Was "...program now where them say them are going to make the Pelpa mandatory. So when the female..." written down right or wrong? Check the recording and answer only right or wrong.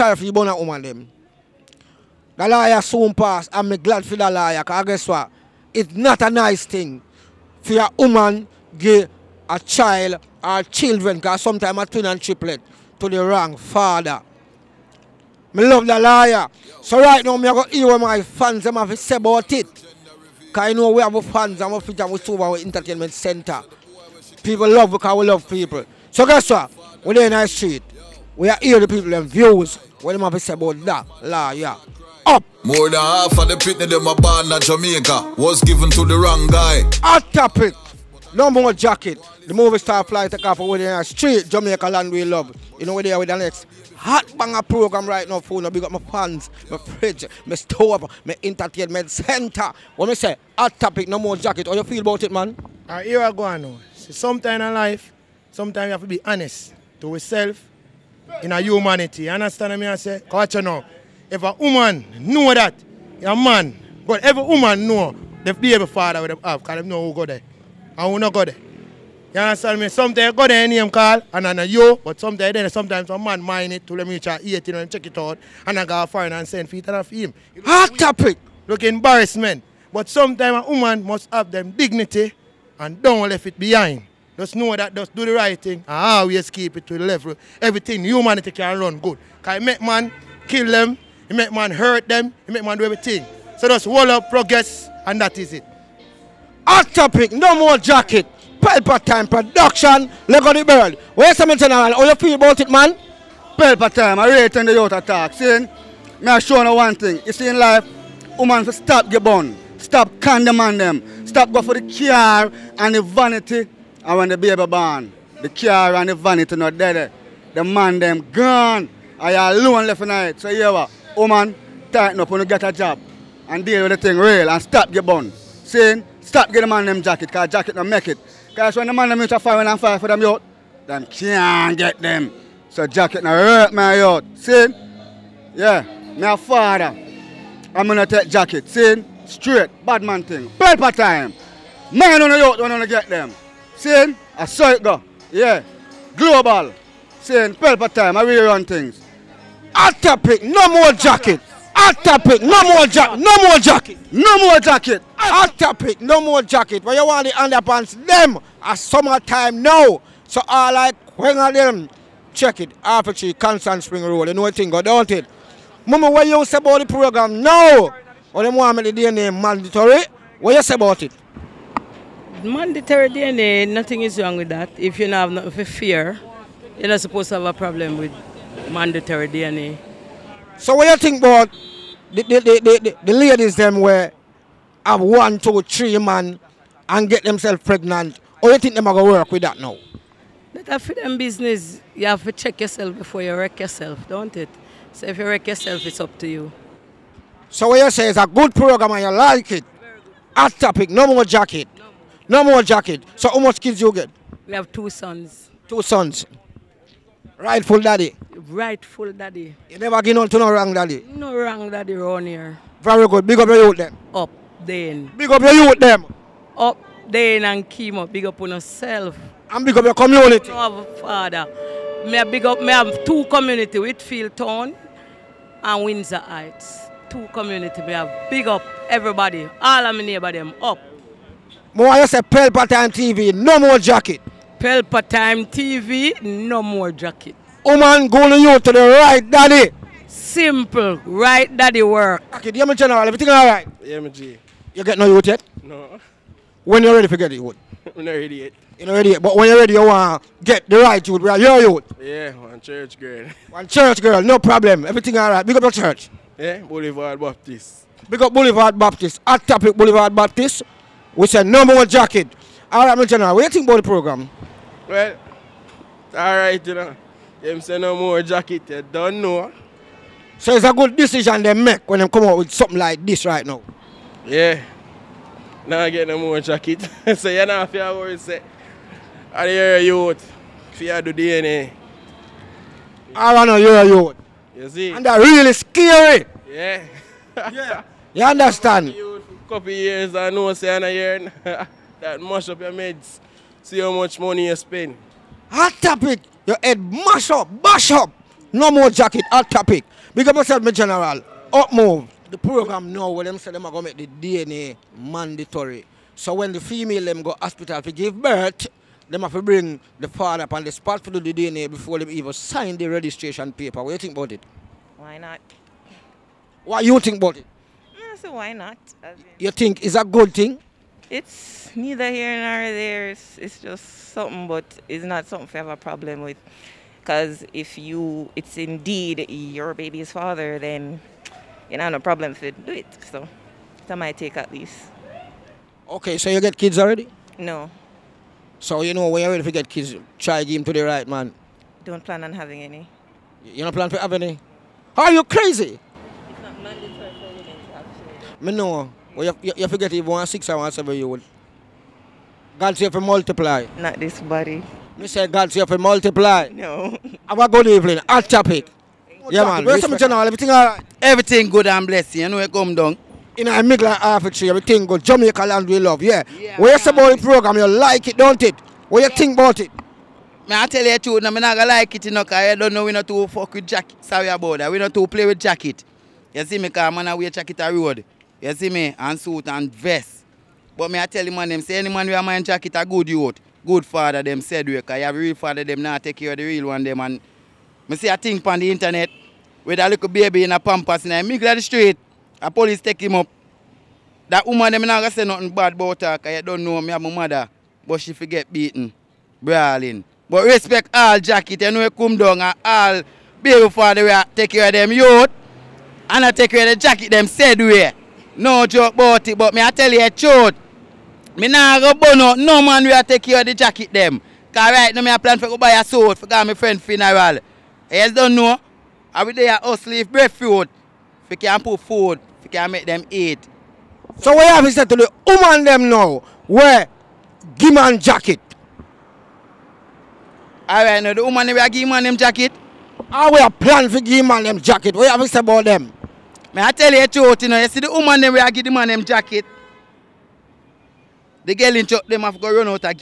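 wrong.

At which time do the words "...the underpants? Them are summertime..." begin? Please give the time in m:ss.
2:37.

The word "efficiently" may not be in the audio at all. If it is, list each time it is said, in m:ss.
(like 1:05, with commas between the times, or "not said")
not said.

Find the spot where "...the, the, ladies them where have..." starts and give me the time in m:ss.
3:02.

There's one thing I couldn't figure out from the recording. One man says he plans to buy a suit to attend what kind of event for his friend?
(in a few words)
funeral.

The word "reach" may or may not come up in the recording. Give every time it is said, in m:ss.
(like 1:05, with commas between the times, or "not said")
1:14.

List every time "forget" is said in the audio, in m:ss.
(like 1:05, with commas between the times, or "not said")
4:07, 5:49, 6:38.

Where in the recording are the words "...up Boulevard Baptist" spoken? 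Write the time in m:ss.
4:18.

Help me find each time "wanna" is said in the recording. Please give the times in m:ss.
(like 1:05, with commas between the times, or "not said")
4:43.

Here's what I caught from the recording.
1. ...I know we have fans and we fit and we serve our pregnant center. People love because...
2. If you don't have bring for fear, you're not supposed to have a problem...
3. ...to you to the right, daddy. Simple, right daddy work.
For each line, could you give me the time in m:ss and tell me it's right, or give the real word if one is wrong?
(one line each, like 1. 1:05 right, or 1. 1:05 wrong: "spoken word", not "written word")
1. 0:20 wrong: "entertainment", not "pregnant"
2. 2:54 wrong: "nothing", not "bring"
3. 3:58 right.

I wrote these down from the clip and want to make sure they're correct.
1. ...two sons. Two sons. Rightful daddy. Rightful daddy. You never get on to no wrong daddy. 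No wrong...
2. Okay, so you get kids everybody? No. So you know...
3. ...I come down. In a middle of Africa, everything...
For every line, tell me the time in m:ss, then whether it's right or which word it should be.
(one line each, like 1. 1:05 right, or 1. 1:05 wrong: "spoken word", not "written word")
1. 3:24 right
2. 5:35 wrong: "already", not "everybody"
3. 6:02 right.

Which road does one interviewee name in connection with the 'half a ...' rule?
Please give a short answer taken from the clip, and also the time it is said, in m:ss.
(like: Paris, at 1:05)
Constant Spring, at 2:43.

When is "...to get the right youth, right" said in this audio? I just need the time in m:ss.
4:10.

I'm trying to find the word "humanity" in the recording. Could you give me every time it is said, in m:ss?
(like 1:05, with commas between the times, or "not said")
0:58, 1:28.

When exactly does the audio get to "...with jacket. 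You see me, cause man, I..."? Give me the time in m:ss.
6:15.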